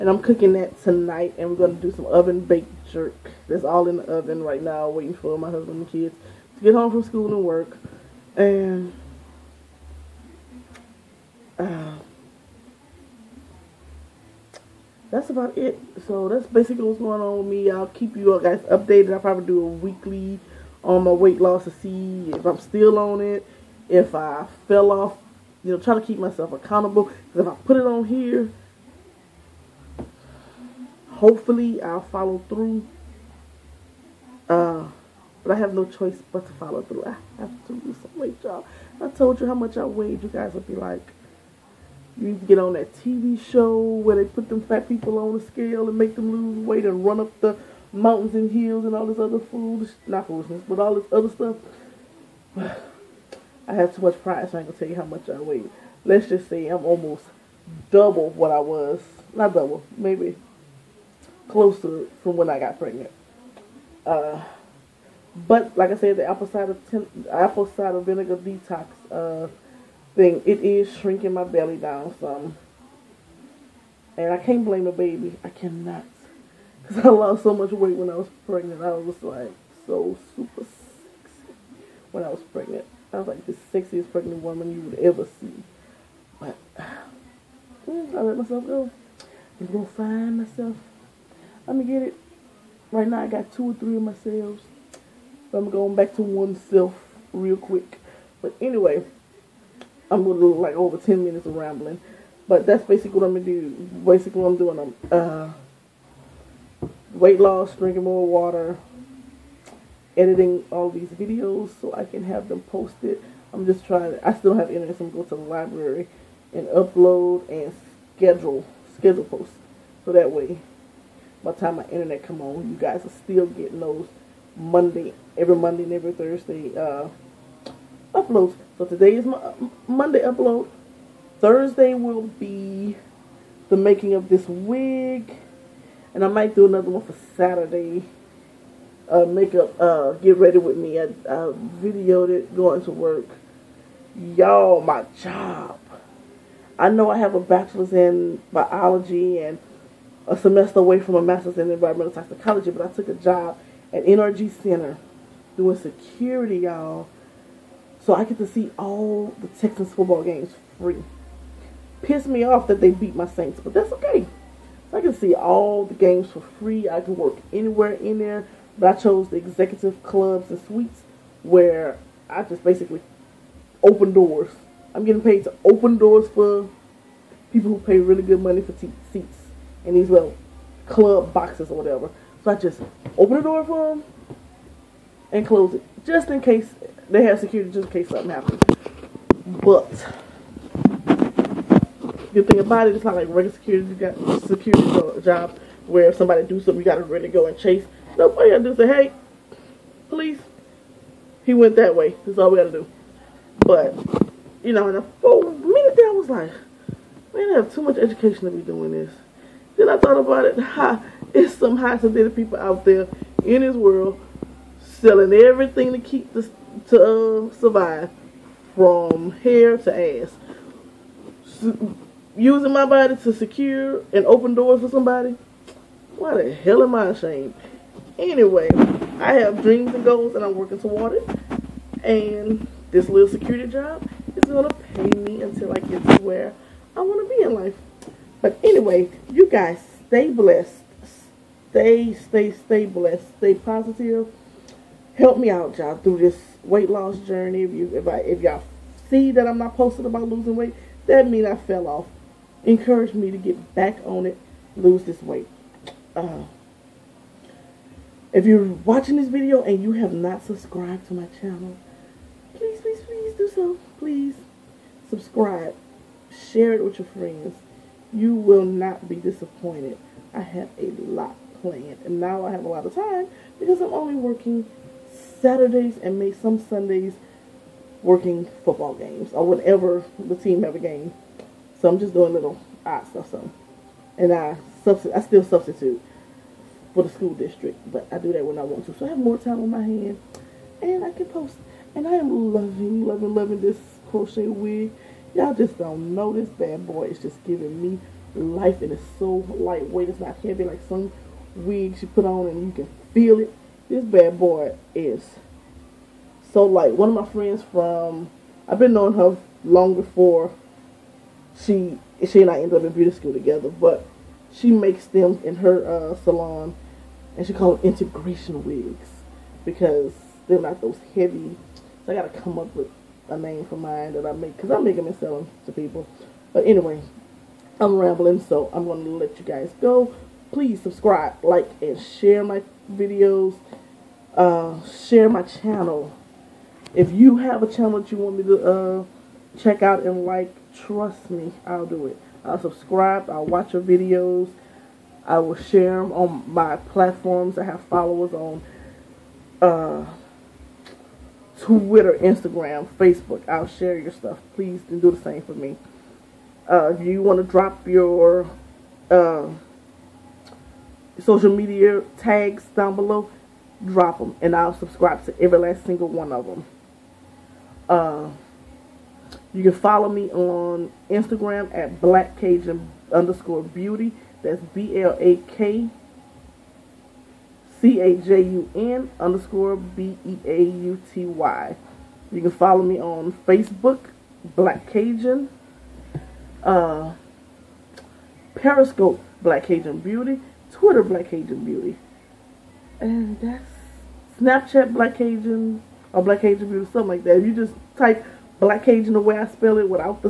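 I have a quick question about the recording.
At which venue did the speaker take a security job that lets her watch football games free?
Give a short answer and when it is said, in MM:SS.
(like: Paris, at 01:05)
NRG Center, at 02:34.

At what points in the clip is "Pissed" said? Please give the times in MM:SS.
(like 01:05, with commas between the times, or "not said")
02:42.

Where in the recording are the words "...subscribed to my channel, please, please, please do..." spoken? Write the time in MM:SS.
04:20.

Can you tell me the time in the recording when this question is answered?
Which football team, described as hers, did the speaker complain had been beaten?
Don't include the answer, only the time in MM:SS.
02:43.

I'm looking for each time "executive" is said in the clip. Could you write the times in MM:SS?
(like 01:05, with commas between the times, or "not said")
02:49.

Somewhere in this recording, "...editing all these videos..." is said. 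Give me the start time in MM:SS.
01:50.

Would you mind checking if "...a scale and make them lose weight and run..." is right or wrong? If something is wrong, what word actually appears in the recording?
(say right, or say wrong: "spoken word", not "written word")
right.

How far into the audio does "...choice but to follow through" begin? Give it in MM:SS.
00:35.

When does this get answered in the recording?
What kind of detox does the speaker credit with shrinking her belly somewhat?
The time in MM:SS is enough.
01:07.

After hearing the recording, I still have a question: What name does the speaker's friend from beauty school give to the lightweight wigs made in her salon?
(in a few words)
integration wigs.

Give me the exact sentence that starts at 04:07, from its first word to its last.
If you, if I, if y'all see that I'm not posted about losing weight, that means I fell off.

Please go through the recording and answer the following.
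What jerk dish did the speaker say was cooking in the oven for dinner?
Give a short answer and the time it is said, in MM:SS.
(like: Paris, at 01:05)
oven baked jerk, at 00:02.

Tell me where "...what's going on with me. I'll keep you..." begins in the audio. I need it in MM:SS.
00:16.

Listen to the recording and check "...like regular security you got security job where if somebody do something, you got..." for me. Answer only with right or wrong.
right.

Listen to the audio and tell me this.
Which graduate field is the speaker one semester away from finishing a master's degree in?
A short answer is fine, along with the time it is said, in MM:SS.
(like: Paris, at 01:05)
environmental toxicology, at 02:31.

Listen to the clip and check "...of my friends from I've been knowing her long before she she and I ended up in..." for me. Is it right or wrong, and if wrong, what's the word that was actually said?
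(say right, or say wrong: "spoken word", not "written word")
right.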